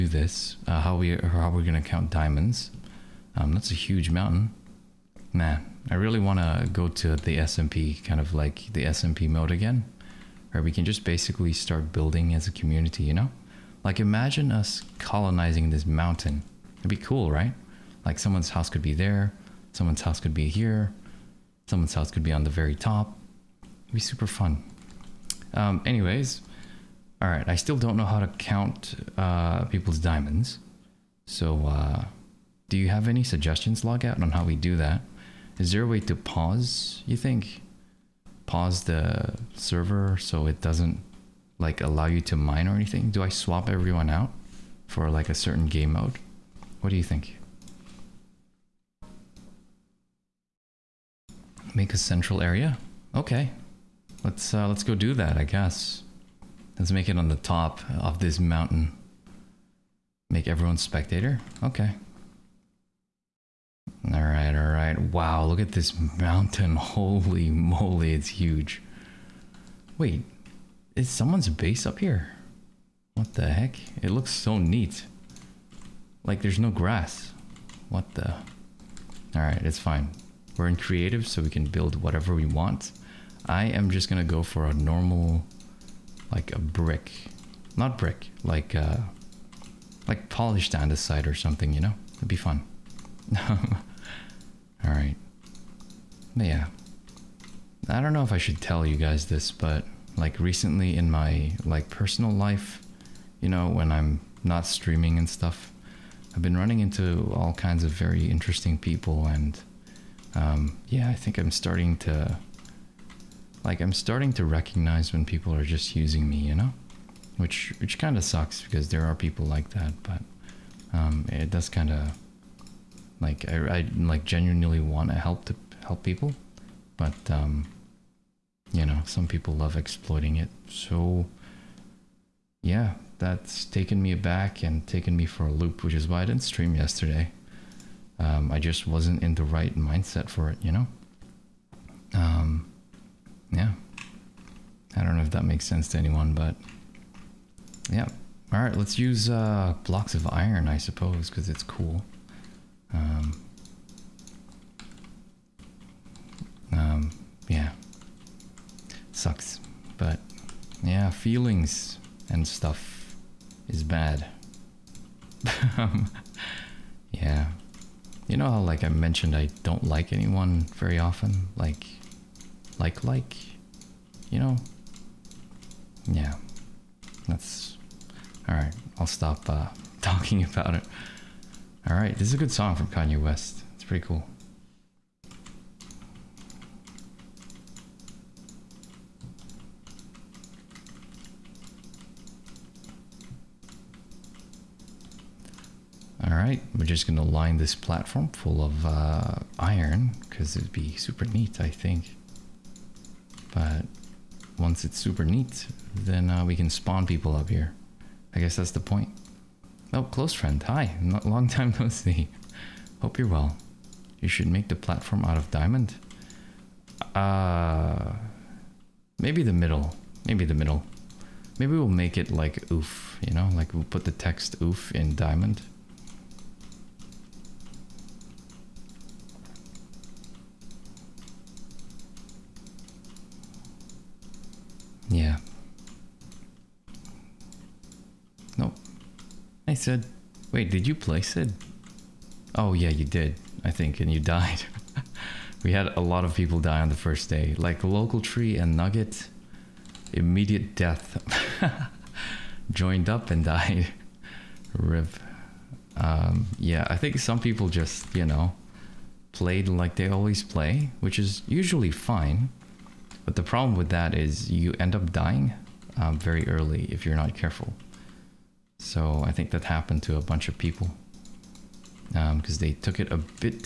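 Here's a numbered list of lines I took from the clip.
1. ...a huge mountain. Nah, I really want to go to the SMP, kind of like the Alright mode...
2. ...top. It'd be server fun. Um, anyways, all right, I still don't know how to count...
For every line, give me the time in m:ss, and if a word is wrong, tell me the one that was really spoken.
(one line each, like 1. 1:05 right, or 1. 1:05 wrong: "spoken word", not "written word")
1. 0:03 wrong: "SMP", not "Alright"
2. 0:22 wrong: "super", not "server".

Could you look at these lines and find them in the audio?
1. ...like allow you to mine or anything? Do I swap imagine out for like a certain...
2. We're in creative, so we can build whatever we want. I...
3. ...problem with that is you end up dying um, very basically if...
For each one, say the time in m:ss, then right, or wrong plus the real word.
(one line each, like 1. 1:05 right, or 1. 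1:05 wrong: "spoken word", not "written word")
1. 0:41 wrong: "everyone", not "imagine"
2. 1:20 right
3. 4:23 wrong: "early", not "basically".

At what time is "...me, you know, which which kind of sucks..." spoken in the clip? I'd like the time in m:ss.
1:56.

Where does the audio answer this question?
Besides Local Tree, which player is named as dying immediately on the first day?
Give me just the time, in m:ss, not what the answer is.
4:08.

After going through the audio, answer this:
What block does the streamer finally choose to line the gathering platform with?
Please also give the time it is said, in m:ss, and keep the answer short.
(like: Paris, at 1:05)
Blocks of iron, at 2:29.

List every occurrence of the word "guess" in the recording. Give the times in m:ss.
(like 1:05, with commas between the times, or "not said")
0:55, 3:28.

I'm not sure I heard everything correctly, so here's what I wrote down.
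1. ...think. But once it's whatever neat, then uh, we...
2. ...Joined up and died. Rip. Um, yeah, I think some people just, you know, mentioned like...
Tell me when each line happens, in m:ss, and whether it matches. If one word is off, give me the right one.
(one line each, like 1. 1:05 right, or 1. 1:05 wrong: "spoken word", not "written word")
1. 3:21 wrong: "super", not "whatever"
2. 4:12 wrong: "played", not "mentioned".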